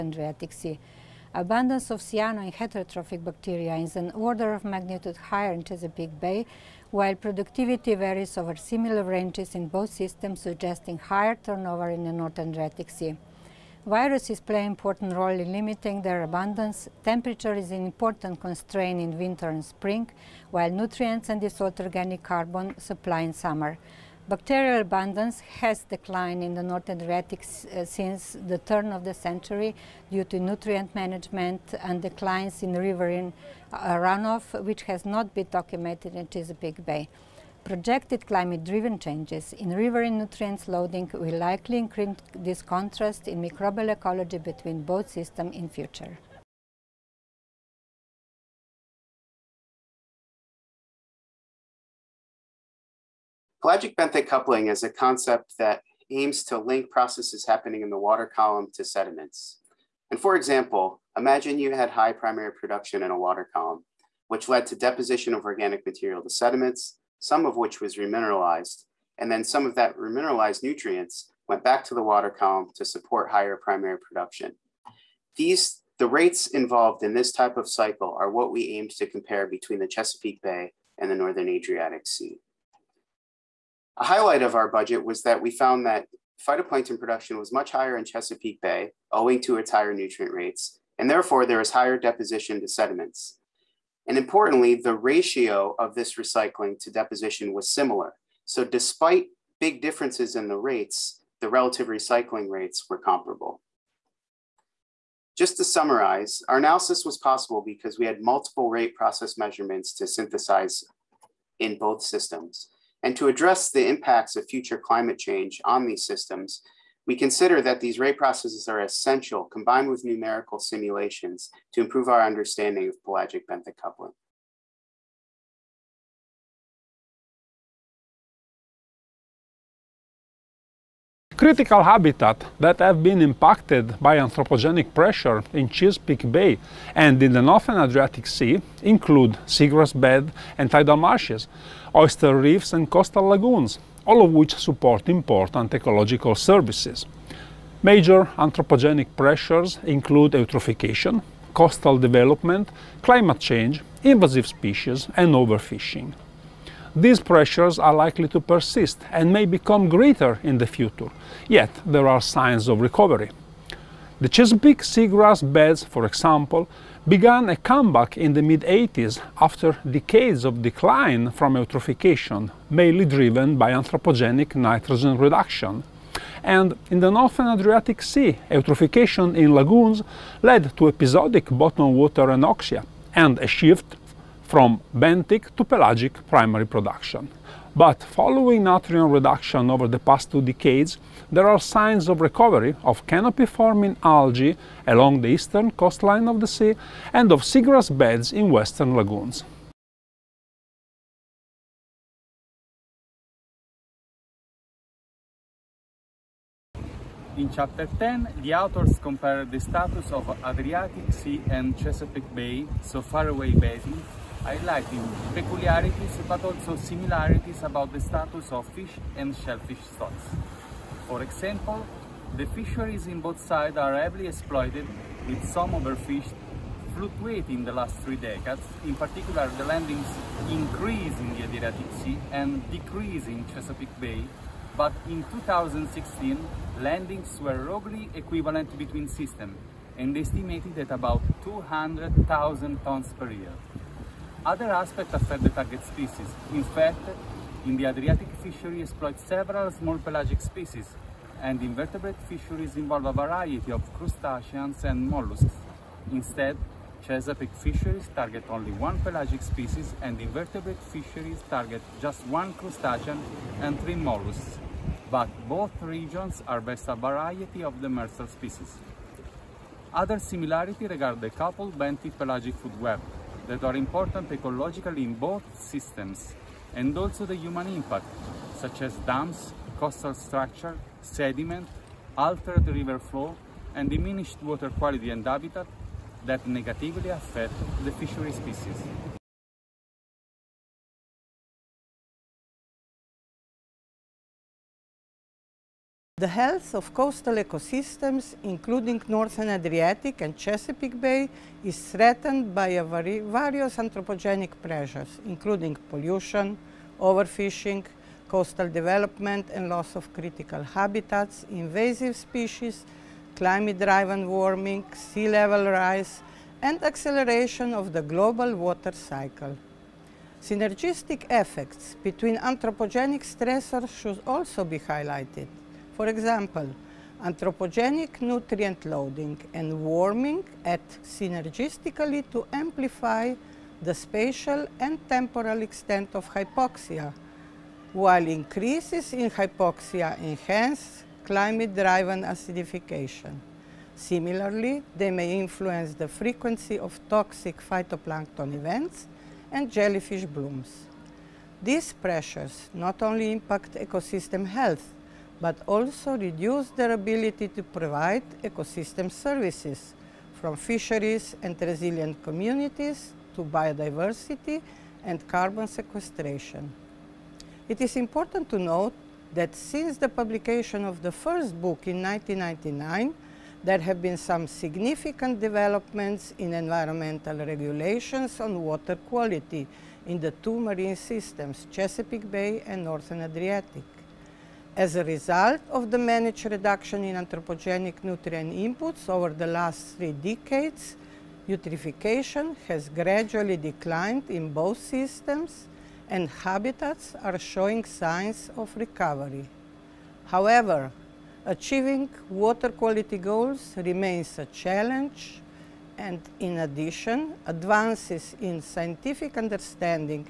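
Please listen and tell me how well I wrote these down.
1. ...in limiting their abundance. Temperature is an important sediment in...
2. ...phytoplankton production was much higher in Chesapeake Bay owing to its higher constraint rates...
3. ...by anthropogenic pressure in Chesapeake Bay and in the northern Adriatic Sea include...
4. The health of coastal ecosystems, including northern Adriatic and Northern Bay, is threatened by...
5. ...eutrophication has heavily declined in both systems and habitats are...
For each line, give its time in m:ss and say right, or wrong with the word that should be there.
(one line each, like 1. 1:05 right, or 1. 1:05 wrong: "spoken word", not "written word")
1. 0:15 wrong: "constraint", not "sediment"
2. 1:26 wrong: "nutrient", not "constraint"
3. 2:13 right
4. 4:56 wrong: "Chesapeake", not "Northern"
5. 6:31 wrong: "gradually", not "heavily".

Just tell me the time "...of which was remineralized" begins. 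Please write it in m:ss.
1:07.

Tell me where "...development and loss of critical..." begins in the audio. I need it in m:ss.
5:08.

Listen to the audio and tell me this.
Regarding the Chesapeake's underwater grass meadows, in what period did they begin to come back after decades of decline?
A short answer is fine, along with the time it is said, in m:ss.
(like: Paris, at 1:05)
Mid 80s, at 2:48.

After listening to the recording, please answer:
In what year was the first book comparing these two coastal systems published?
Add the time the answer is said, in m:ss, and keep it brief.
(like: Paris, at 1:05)
1999, at 6:12.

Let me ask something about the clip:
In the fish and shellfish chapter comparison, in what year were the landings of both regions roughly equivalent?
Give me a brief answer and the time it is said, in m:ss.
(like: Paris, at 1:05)
2016, at 3:55.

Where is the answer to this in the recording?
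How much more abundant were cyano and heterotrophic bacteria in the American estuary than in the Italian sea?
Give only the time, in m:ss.
0:03.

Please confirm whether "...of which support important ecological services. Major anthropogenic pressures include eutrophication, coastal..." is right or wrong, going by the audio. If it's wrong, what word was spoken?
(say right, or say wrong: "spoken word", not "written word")
right.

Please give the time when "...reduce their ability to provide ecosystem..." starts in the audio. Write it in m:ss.
5:56.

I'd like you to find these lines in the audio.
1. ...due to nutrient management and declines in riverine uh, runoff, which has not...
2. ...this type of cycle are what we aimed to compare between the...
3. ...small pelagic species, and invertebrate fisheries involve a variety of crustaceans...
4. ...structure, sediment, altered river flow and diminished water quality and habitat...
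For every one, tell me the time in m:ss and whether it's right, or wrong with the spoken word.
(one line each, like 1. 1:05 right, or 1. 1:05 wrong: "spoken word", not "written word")
1. 0:30 right
2. 1:17 right
3. 4:09 right
4. 4:40 right.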